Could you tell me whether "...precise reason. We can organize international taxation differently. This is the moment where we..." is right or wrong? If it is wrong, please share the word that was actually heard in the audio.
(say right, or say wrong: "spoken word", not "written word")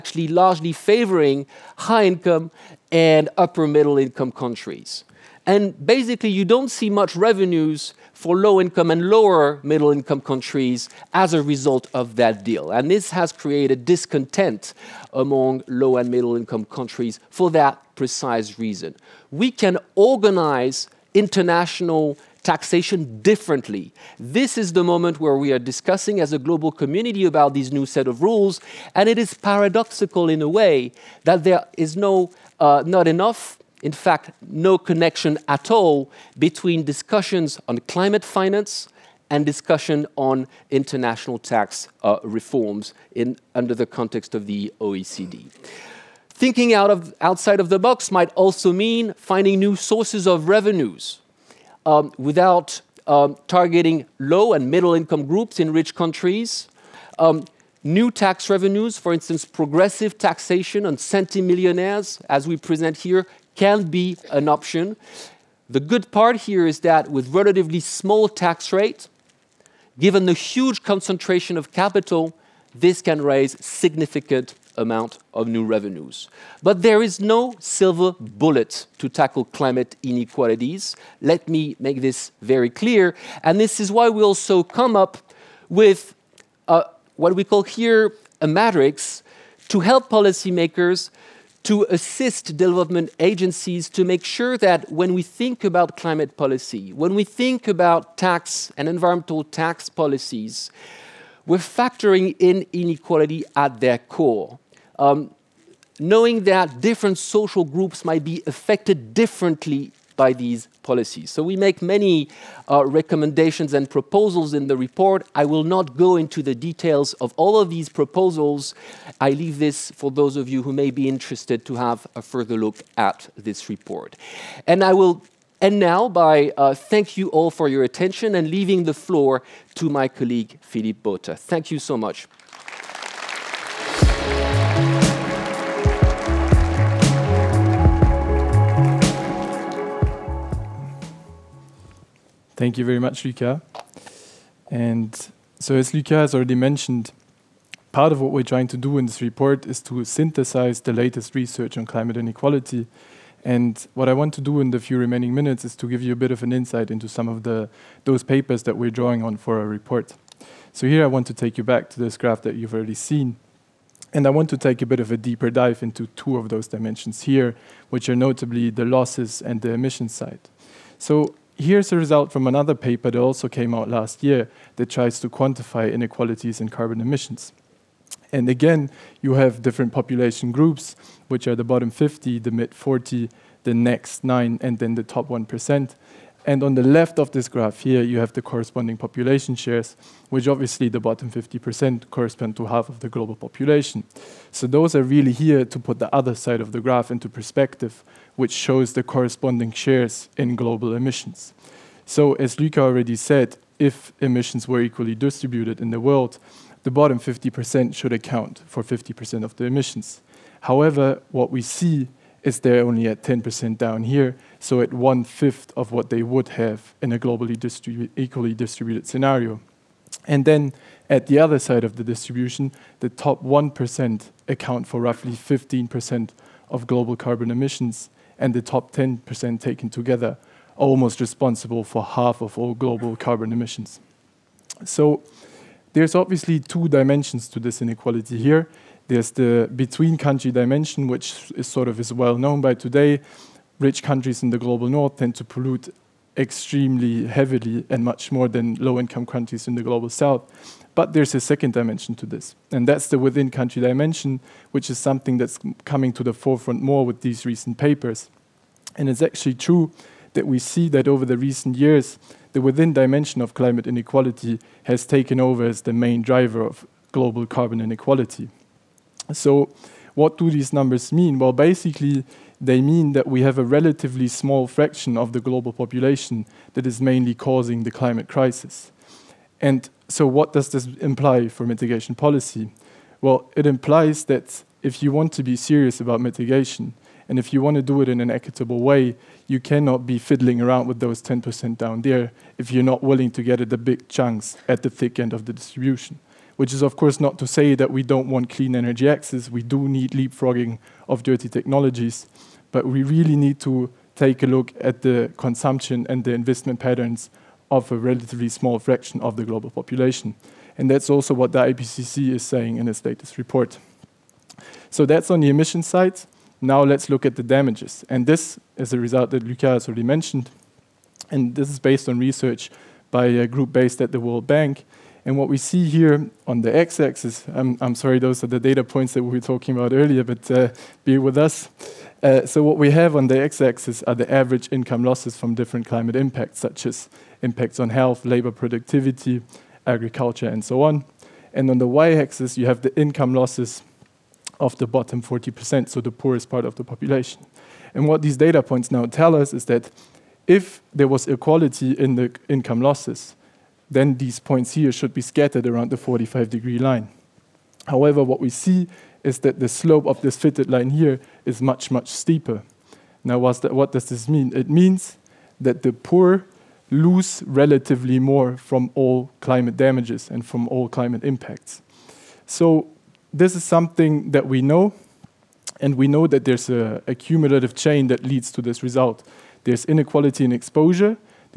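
right.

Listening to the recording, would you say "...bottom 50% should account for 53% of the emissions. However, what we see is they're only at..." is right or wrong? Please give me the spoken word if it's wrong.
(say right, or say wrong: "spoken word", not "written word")
wrong: "50", not "53".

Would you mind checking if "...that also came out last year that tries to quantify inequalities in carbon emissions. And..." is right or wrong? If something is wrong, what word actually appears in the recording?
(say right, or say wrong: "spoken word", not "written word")
right.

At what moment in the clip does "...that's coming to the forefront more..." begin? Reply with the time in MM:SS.
04:15.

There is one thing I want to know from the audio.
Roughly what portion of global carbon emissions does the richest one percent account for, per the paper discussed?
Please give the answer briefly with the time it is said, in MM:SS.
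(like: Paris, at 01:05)
15%, at 03:45.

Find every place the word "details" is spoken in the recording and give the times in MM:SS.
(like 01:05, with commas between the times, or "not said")
01:56.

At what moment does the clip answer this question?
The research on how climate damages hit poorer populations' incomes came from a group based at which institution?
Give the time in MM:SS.
05:24.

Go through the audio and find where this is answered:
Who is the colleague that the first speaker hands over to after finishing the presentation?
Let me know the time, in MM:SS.
02:10.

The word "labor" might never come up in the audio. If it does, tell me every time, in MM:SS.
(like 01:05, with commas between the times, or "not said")
05:38.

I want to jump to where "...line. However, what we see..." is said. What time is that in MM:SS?
05:56.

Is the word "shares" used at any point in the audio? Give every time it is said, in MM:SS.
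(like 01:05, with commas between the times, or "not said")
03:09, 03:19.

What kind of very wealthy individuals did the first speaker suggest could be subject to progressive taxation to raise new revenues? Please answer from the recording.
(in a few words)
Centimillionaires.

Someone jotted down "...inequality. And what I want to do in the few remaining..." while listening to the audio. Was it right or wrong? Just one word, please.
right.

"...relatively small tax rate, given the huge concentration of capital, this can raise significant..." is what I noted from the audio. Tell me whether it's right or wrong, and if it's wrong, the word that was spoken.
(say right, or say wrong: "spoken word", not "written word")
right.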